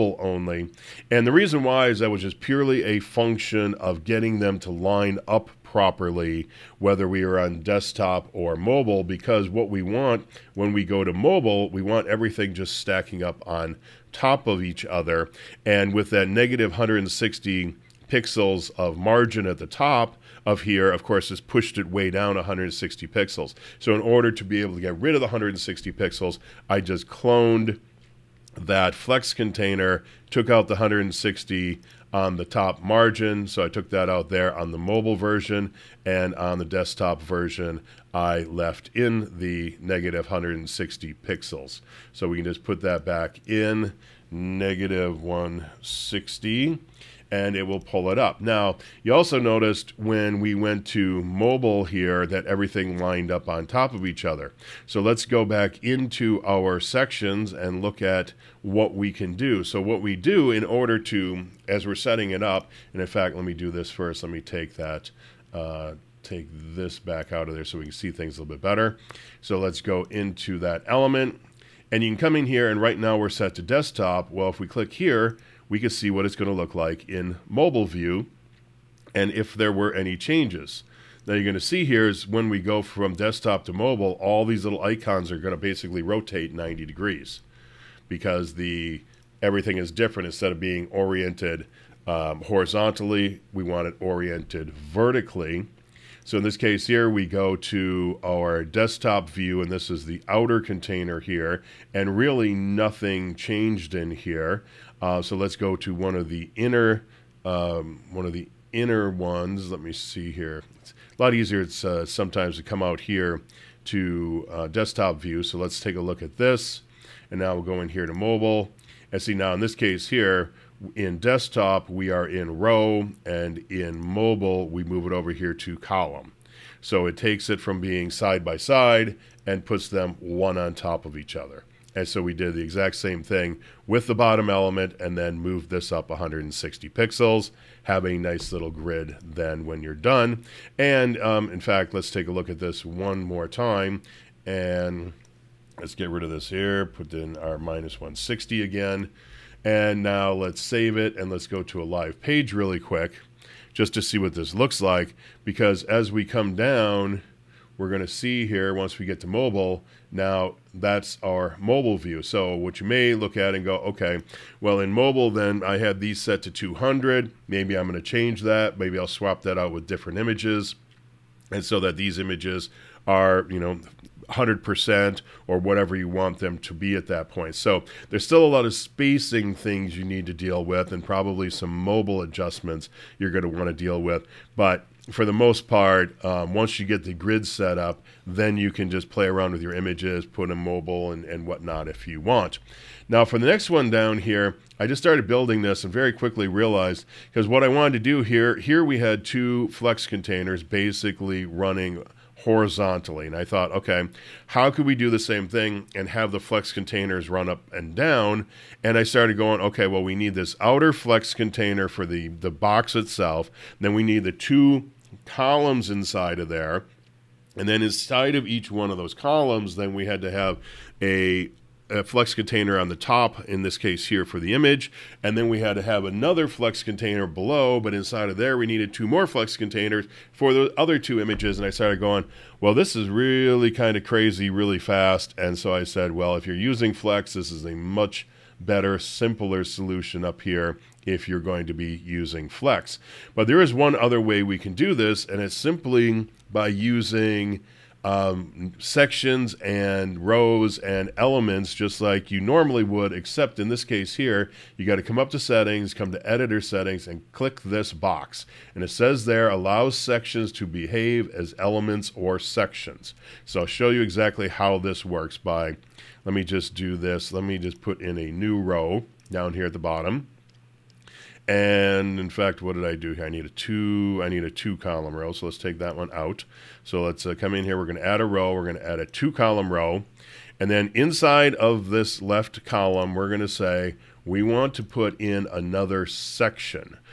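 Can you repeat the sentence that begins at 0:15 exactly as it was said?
And with that negative 160 pixels of margin at the top, of here, of course, has pushed it way down 160 pixels.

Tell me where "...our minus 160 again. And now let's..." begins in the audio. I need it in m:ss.
2:27.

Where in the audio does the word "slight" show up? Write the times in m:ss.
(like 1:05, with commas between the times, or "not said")
not said.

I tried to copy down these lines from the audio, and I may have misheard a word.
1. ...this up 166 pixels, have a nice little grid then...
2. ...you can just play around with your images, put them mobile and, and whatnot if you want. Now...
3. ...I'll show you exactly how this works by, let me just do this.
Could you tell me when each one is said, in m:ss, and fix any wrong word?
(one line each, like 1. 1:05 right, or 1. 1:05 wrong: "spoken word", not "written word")
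1. 2:15 wrong: "160", not "166"
2. 3:08 right
3. 4:23 right.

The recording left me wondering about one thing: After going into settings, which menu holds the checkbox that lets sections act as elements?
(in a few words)
editor settings.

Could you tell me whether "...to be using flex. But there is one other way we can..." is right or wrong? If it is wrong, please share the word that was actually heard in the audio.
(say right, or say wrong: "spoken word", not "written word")
right.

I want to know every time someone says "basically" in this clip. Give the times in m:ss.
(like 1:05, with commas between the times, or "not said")
1:25, 3:20.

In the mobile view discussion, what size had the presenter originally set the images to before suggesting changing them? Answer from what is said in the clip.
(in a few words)
200.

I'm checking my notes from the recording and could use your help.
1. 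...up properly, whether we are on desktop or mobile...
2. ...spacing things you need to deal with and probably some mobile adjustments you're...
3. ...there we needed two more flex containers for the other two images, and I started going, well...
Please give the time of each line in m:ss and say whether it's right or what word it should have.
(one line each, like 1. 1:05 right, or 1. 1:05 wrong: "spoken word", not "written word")
1. 0:05 right
2. 2:58 right
3. 3:48 right.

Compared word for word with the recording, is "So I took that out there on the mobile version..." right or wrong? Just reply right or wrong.
right.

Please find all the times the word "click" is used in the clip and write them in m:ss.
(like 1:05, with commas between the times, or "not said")
1:14, 4:17.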